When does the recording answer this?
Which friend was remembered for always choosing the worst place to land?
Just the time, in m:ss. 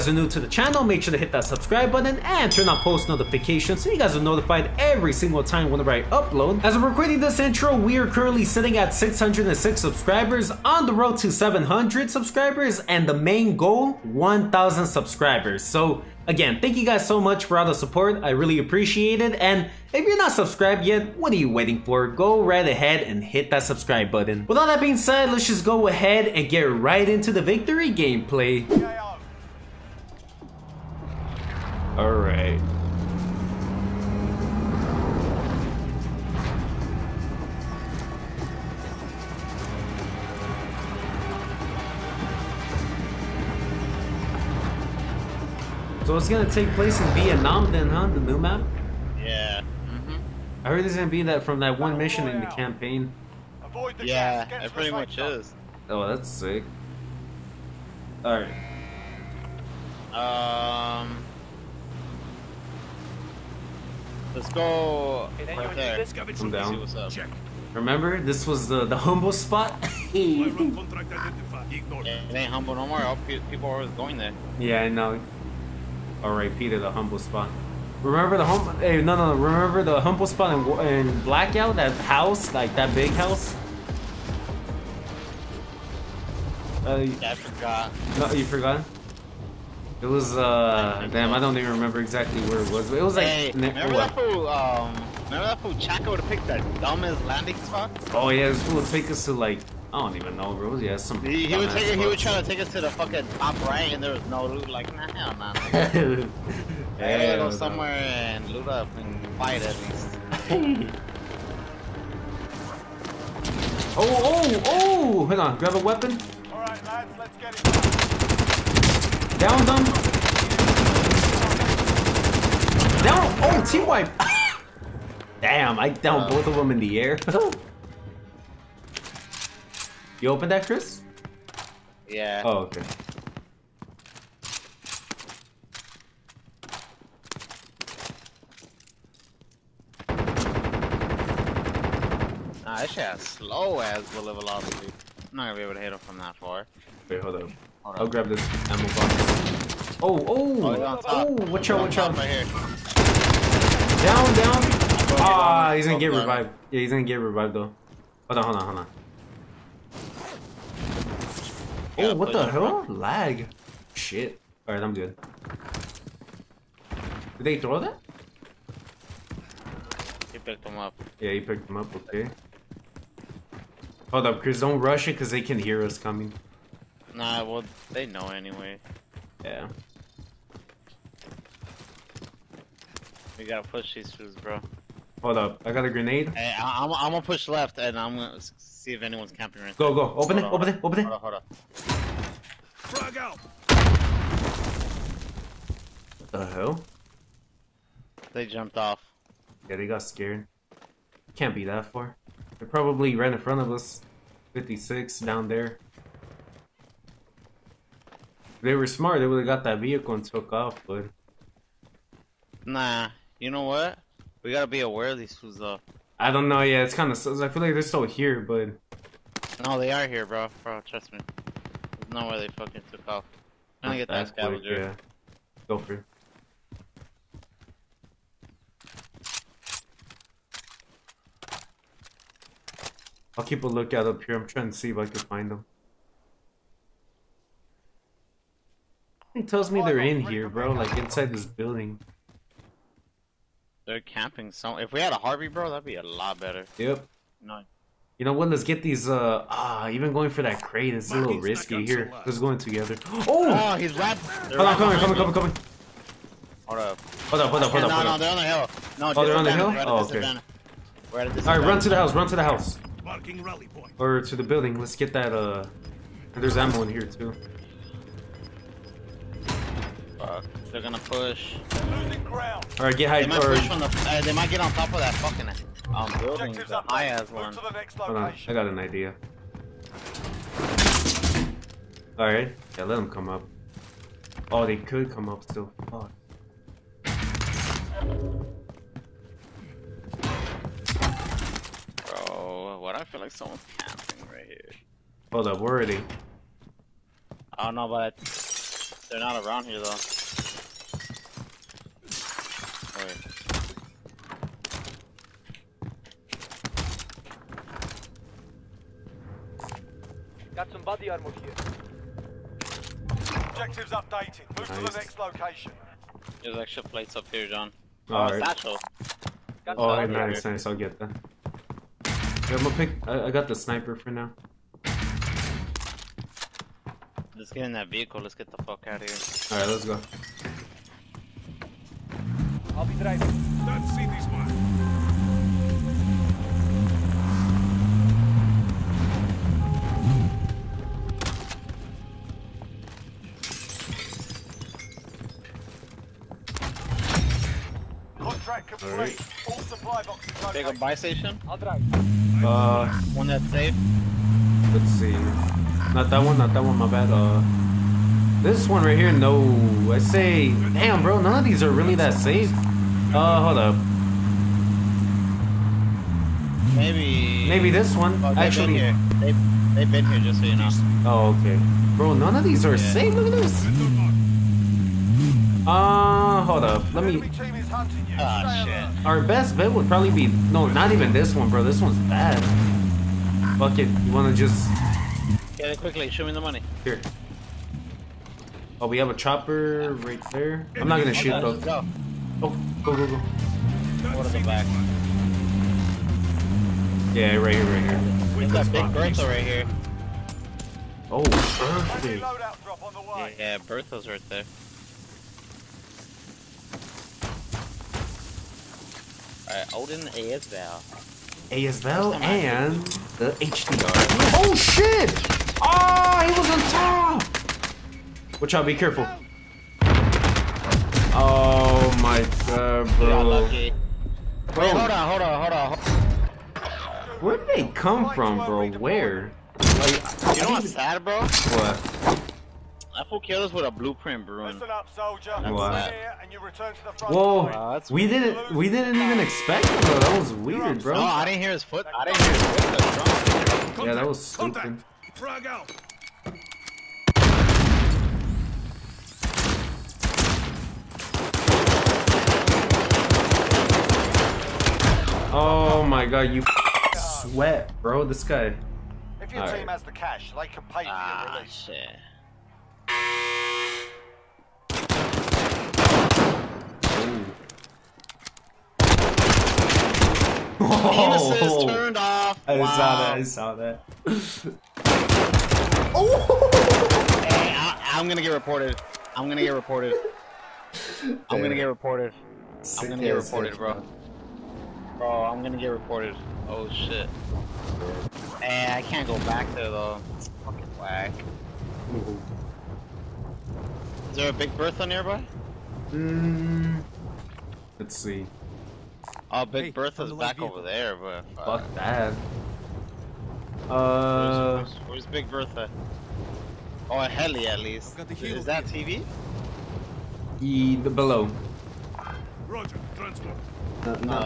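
1:35.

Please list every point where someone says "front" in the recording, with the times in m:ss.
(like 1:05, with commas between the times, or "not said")
3:23, 7:16.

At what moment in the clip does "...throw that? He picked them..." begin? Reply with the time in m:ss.
2:47.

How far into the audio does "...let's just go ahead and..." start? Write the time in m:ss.
0:25.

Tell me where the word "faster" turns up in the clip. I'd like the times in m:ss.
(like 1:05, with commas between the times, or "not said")
not said.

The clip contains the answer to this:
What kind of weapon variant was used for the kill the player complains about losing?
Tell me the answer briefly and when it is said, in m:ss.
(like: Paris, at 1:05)
blueprint, at 7:13.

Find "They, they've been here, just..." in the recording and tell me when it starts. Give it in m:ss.
6:09.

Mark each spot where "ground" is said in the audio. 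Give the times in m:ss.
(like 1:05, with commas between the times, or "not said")
4:32.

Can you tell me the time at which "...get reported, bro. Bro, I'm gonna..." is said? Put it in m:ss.
8:03.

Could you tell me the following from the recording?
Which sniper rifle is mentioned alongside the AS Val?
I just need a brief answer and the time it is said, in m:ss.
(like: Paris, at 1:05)
HDR, at 6:53.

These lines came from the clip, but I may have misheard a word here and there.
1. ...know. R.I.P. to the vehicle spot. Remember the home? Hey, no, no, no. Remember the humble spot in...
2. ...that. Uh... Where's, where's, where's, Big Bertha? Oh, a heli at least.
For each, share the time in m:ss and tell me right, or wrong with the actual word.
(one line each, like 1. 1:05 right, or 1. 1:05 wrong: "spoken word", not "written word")
1. 1:14 wrong: "humble", not "vehicle"
2. 8:21 right.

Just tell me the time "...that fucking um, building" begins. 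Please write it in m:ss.
4:34.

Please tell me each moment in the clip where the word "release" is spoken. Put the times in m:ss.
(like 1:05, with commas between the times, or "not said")
7:41.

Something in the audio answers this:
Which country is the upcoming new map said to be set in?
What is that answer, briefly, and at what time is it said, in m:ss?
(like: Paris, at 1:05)
Vietnam, at 0:47.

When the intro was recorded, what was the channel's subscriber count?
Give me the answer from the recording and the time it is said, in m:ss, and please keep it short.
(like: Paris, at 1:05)
606, at 0:08.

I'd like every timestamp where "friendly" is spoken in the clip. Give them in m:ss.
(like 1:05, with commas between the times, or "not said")
not said.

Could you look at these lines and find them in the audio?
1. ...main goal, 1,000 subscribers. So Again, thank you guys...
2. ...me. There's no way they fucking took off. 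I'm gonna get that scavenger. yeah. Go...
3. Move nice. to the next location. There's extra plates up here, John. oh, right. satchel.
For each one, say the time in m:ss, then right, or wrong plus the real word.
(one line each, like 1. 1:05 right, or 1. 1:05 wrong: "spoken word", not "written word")
1. 0:13 right
2. 3:41 right
3. 5:14 right.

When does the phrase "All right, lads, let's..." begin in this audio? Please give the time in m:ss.
1:56.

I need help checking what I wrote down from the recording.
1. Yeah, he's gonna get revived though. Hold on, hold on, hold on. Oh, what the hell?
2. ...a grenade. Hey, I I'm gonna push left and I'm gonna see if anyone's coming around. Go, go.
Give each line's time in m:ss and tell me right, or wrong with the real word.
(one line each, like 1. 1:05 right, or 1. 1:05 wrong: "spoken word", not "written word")
1. 2:36 right
2. 3:05 wrong: "camping", not "coming".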